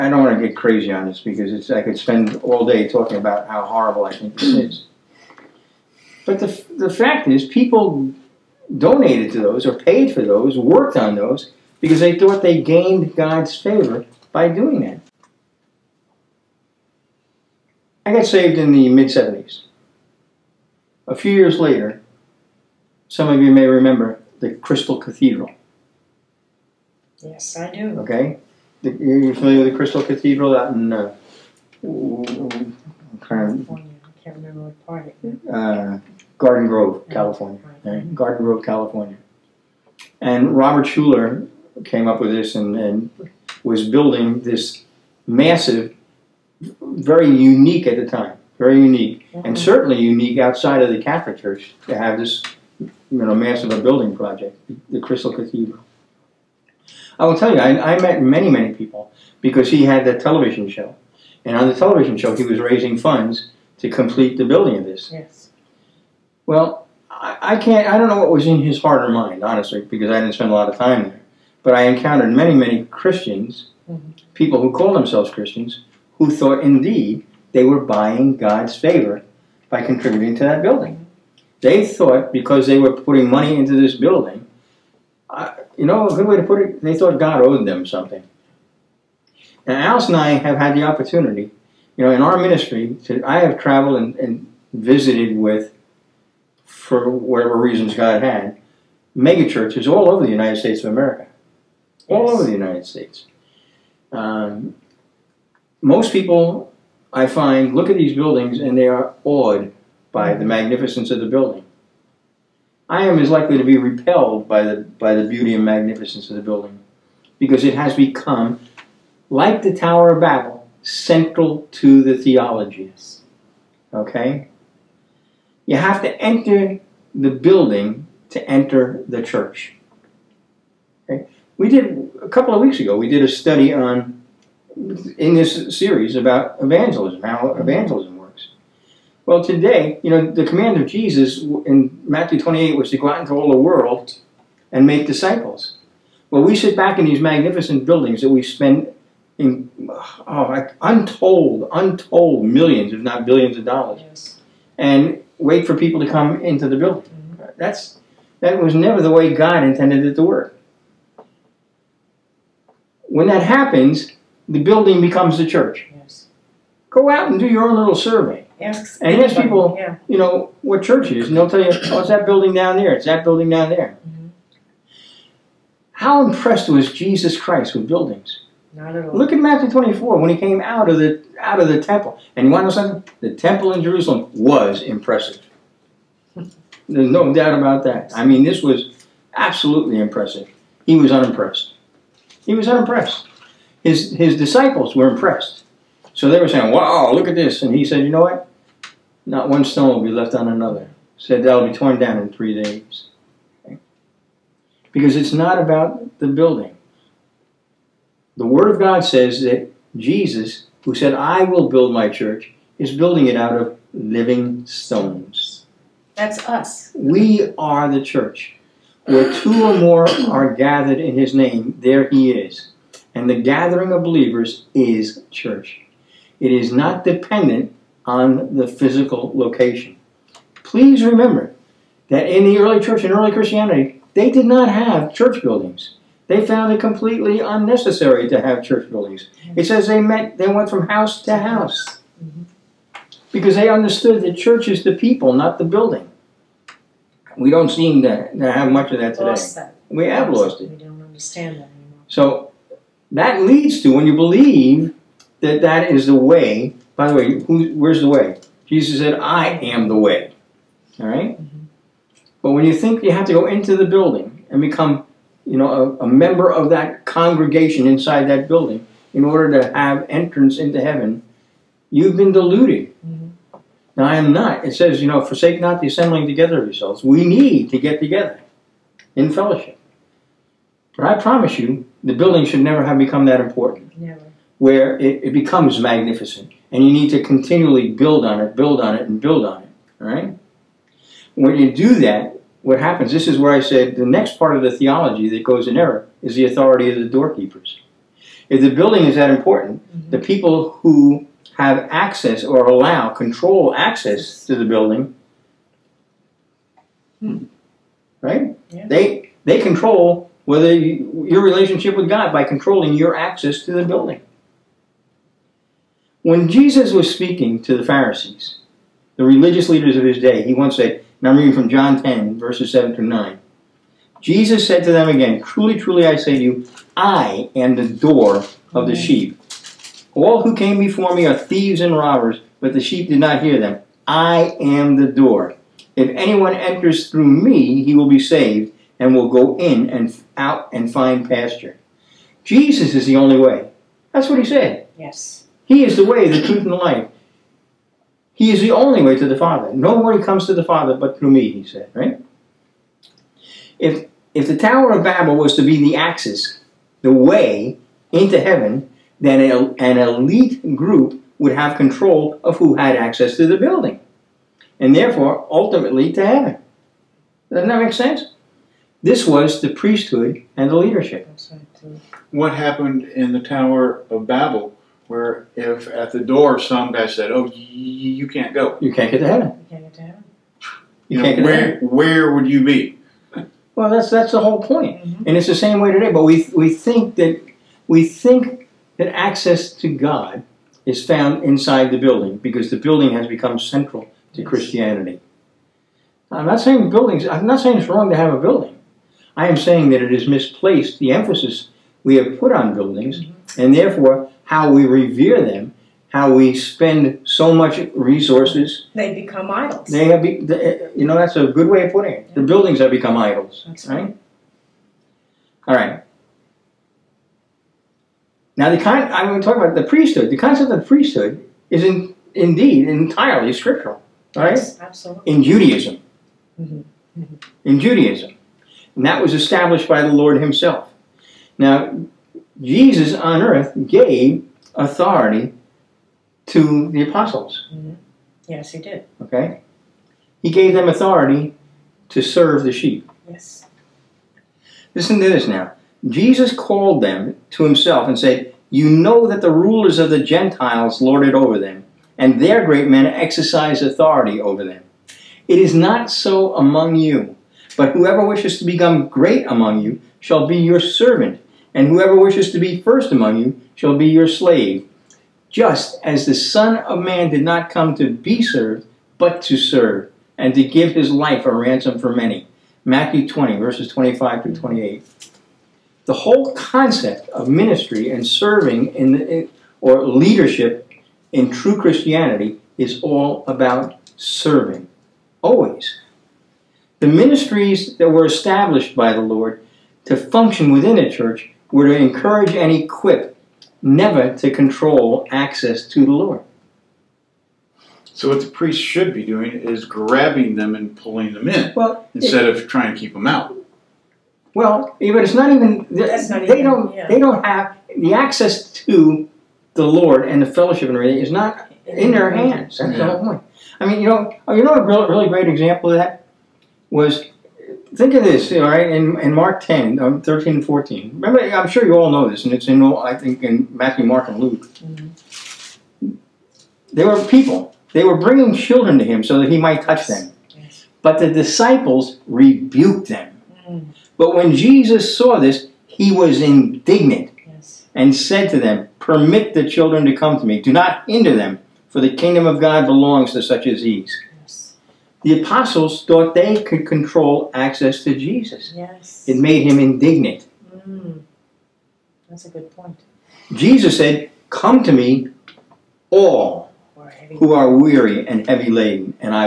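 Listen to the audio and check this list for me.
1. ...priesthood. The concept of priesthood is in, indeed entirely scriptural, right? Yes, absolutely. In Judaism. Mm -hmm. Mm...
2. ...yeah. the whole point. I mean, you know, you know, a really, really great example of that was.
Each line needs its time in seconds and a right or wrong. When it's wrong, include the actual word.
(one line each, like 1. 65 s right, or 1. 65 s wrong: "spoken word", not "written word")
1. 419 s right
2. 512 s right.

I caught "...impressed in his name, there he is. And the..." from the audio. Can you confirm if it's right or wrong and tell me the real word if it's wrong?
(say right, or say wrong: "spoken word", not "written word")
wrong: "gathered", not "impressed".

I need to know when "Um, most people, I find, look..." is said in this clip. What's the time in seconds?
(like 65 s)
104 s.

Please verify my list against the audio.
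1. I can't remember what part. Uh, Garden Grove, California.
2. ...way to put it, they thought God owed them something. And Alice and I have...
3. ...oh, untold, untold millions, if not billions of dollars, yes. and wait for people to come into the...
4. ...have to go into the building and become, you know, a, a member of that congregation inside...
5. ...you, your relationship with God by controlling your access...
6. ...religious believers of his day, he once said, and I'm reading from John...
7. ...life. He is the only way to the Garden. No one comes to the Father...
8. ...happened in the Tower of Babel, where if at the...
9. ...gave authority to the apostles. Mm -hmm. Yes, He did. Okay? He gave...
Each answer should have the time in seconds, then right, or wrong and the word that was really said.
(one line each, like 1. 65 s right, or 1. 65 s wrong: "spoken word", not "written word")
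1. 34 s right
2. 86 s right
3. 149 s right
4. 263 s right
5. 310 s right
6. 319 s wrong: "leaders", not "believers"
7. 346 s wrong: "Father", not "Garden"
8. 372 s right
9. 433 s right.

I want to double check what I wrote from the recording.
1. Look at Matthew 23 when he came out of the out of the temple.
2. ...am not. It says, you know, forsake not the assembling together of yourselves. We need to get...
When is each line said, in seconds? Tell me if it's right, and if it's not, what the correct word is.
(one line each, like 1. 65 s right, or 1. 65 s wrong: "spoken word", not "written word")
1. 179 s wrong: "24", not "23"
2. 274 s right.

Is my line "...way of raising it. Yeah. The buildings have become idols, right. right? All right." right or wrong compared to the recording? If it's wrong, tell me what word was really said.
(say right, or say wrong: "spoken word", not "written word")
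wrong: "putting", not "raising".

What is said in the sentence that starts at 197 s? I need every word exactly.
And he said, you know what?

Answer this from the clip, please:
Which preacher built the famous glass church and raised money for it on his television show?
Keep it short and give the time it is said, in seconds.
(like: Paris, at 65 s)
Robert Schuller, at 40 s.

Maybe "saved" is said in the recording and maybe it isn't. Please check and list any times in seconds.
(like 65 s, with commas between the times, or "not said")
18 s, 338 s.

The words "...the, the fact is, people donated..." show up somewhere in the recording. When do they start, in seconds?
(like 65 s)
6 s.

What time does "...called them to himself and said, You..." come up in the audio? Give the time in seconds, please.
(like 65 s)
446 s.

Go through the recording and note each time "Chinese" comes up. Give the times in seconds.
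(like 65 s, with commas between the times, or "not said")
not said.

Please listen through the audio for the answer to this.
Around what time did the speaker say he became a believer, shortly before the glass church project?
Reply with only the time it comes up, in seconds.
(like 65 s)
18 s.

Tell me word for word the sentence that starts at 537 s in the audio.
and said to them, Permit the children to come to me.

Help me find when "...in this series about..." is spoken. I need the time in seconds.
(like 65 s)
135 s.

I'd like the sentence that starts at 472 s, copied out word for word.
Matthew 20, verses 25 through 28.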